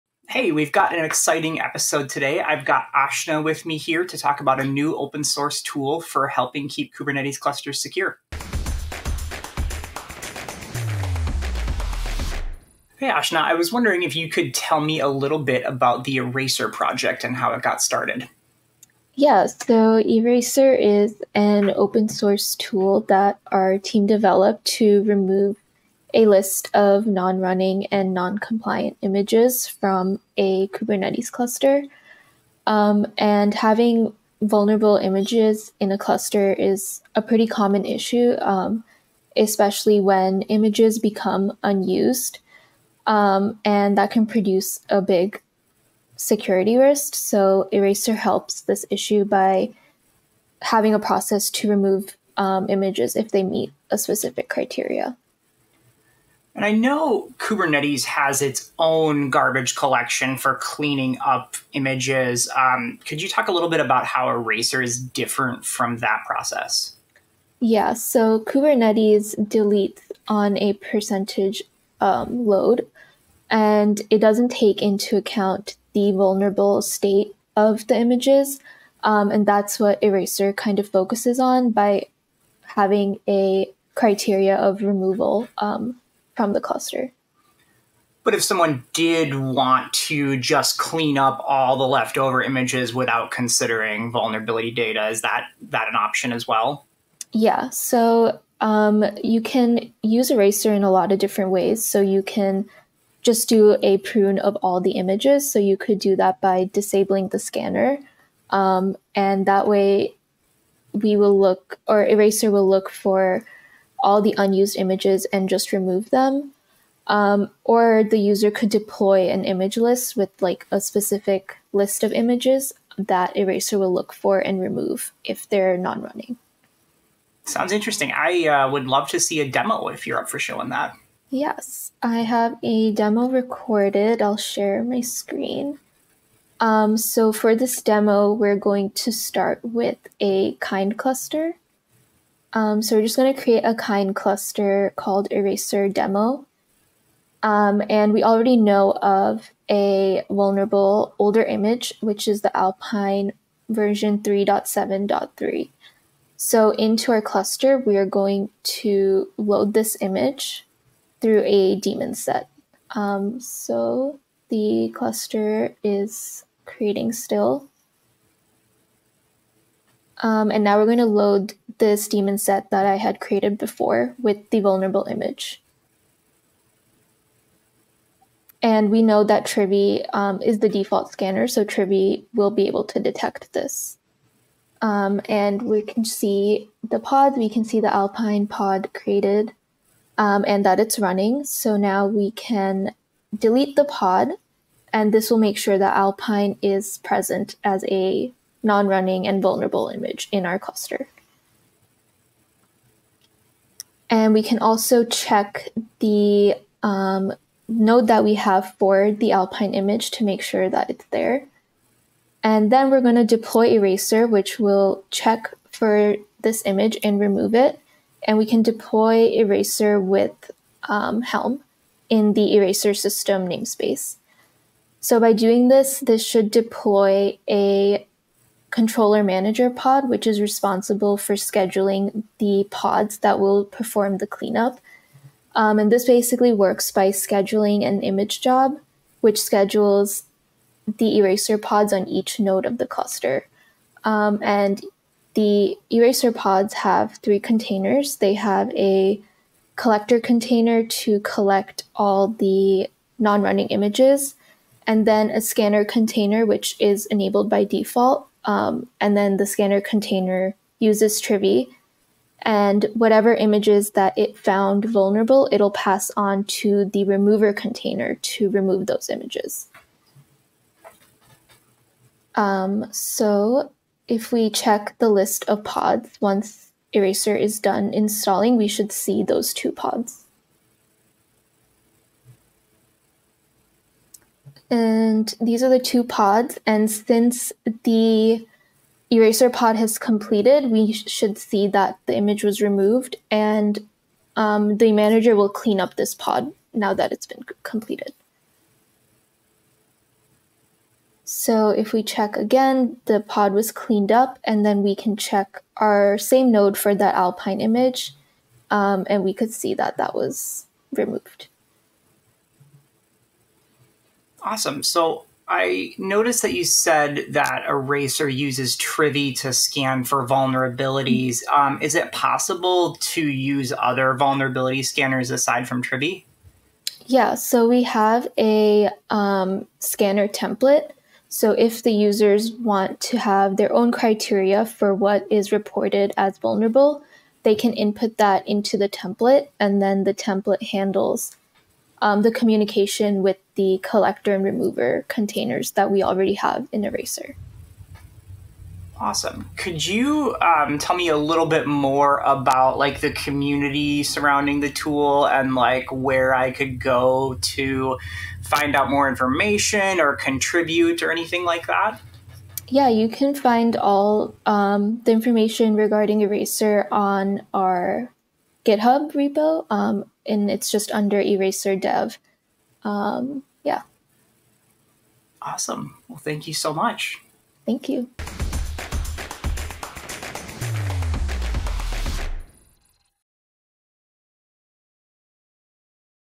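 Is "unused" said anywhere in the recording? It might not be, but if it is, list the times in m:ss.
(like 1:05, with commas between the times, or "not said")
0:41, 1:54.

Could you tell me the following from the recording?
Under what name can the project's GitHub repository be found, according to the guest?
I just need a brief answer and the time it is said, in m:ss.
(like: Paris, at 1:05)
Eraser Dev, at 6:11.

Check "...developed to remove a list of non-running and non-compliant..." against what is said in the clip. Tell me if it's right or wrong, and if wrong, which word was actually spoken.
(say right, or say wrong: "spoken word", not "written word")
right.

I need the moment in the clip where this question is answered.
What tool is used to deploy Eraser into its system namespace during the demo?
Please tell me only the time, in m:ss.
3:41.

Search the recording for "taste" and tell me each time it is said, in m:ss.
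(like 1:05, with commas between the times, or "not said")
not said.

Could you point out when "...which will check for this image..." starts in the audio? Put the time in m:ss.
3:34.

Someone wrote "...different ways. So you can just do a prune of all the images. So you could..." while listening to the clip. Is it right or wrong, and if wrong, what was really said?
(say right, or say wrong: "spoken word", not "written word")
right.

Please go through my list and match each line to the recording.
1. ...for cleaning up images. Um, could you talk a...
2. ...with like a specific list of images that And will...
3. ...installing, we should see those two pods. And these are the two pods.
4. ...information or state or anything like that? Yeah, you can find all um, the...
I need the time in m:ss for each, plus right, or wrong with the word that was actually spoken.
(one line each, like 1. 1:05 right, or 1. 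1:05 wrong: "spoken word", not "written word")
1. 1:00 right
2. 2:00 wrong: "Eraser", not "And"
3. 4:37 right
4. 5:59 wrong: "contribute", not "state".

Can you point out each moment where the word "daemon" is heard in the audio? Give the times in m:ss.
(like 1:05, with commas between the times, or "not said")
2:41, 2:52.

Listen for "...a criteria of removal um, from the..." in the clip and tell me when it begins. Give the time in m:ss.
1:23.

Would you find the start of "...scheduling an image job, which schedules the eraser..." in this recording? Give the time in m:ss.
3:57.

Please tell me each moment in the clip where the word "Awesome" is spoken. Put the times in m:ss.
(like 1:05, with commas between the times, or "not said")
5:14, 5:48, 6:15.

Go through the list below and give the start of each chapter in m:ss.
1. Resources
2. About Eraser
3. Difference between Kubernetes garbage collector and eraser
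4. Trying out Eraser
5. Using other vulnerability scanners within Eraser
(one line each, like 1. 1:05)
1. 5:50
2. 0:13
3. 0:56
4. 2:08
5. 5:15.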